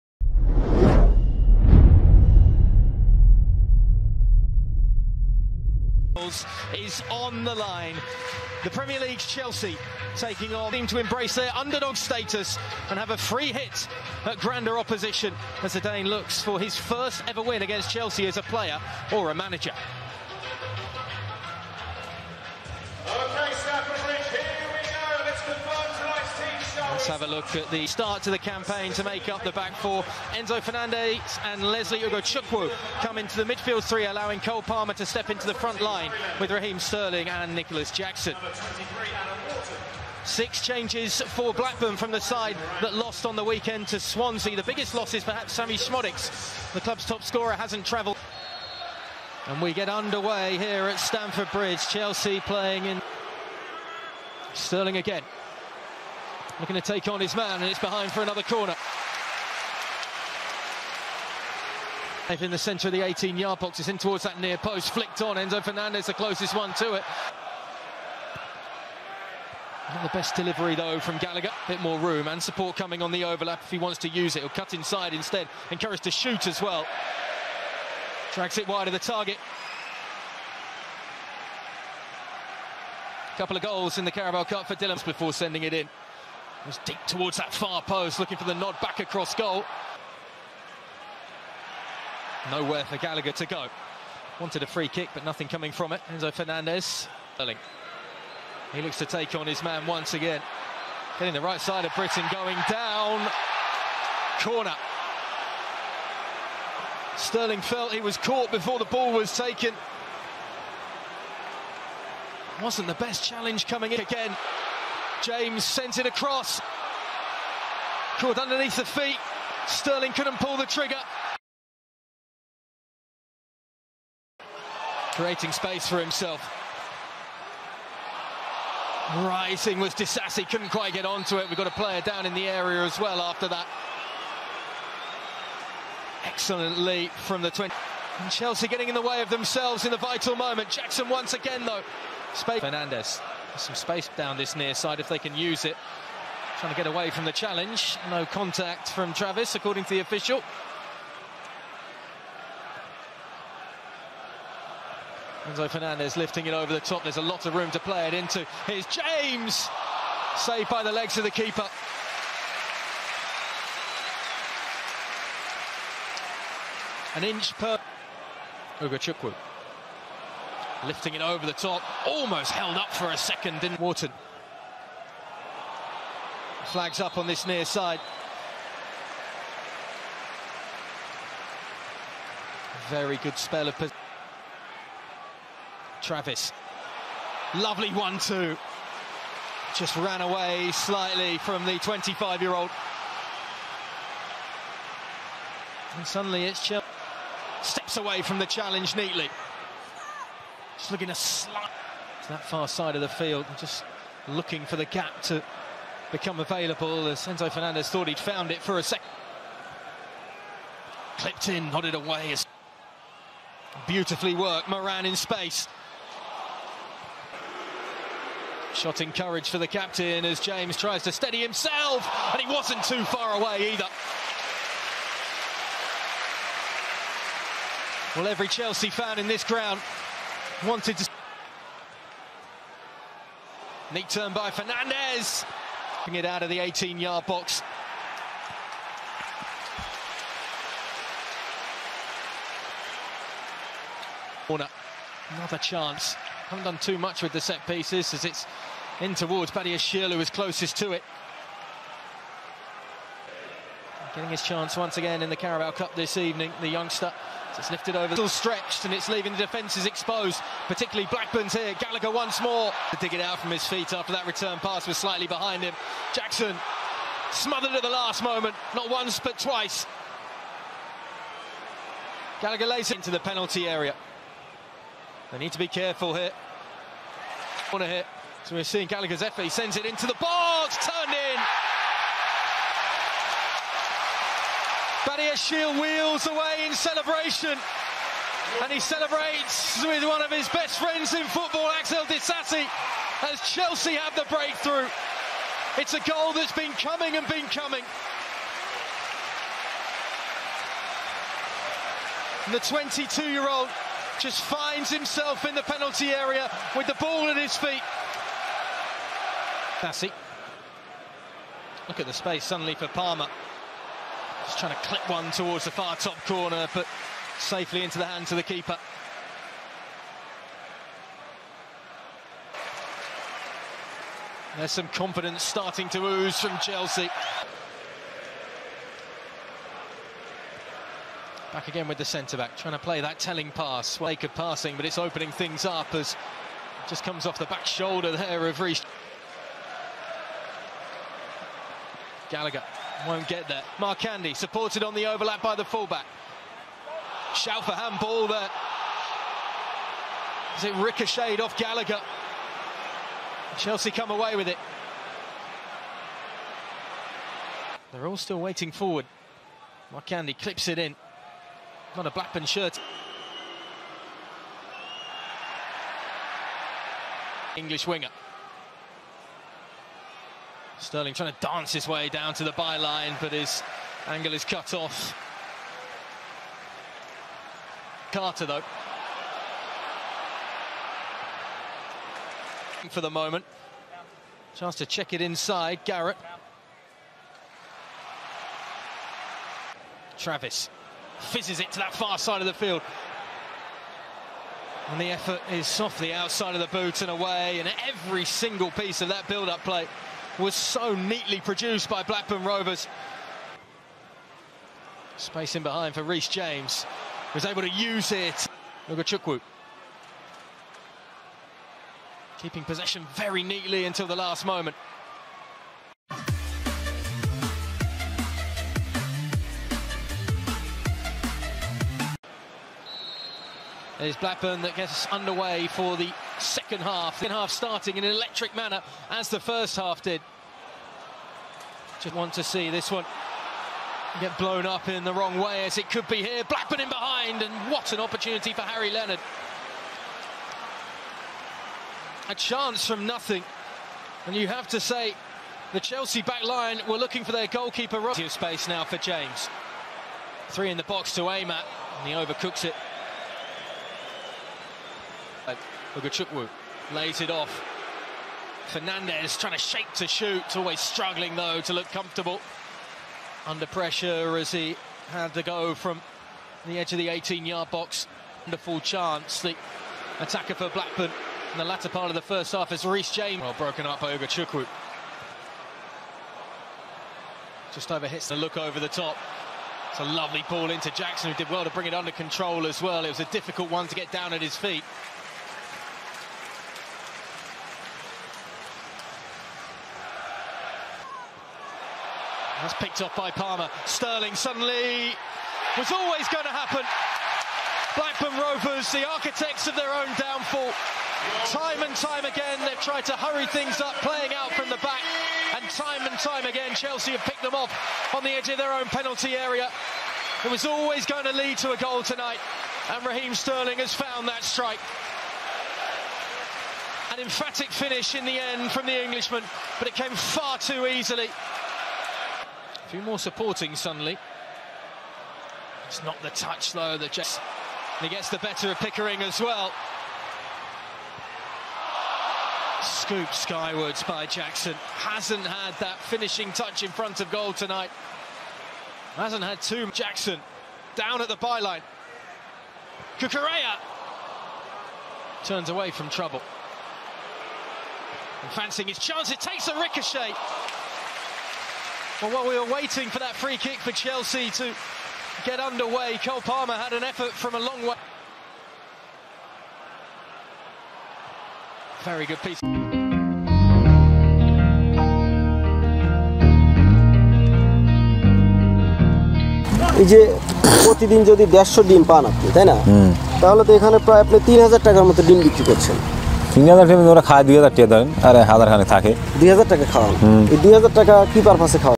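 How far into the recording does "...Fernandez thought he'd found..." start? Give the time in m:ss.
3:27.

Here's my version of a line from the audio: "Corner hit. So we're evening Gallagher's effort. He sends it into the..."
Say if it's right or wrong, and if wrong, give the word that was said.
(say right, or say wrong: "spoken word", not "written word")
wrong: "seeing", not "evening".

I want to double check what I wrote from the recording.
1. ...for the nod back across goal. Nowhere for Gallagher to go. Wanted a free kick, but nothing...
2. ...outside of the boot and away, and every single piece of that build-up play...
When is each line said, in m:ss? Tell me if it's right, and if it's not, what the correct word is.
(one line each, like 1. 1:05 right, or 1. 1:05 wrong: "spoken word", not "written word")
1. 1:28 right
2. 6:36 right.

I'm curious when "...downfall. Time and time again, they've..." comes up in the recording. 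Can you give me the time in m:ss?
8:20.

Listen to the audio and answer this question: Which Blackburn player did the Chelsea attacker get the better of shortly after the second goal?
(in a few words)
Pickering.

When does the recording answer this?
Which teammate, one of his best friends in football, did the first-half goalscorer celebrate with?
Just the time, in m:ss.
4:51.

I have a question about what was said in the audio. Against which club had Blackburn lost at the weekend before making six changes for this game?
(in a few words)
Swansea.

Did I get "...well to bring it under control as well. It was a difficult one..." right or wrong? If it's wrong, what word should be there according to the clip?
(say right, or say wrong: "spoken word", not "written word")
right.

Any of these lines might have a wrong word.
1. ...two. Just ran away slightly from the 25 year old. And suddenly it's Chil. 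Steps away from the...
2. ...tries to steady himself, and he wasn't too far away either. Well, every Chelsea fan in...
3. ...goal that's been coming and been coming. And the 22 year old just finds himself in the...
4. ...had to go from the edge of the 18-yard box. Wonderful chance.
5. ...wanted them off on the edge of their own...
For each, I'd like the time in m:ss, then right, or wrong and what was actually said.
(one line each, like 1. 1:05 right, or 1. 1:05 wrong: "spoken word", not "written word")
1. 3:08 right
2. 3:40 right
3. 4:56 right
4. 7:45 right
5. 8:27 wrong: "picked", not "wanted".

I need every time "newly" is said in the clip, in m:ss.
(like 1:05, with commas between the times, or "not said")
not said.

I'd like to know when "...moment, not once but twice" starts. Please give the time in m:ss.
4:28.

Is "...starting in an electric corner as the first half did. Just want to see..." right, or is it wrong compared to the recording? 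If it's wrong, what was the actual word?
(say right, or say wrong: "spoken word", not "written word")
wrong: "manner", not "corner".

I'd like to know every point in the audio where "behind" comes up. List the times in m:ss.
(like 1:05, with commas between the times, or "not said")
0:57, 4:25, 6:45, 7:16.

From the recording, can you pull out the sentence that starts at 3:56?
Bring it out of the 18-yard box.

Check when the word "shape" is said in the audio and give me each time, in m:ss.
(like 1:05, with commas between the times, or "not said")
7:39.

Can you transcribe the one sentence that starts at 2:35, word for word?
Enzo Fernandez lifting it over the top.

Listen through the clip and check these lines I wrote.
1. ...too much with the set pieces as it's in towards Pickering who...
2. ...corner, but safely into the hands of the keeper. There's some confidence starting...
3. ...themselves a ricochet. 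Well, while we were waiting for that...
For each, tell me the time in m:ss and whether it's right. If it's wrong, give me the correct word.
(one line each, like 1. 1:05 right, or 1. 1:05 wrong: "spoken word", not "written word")
1. 4:06 wrong: "Badiashile", not "Pickering"
2. 5:16 right
3. 9:09 wrong: "takes", not "themselves".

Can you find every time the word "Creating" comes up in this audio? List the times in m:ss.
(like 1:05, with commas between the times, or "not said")
2:05.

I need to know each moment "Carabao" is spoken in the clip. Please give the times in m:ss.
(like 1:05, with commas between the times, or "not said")
1:24, 4:15.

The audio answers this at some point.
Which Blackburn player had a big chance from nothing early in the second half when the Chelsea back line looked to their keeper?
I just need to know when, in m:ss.
7:18.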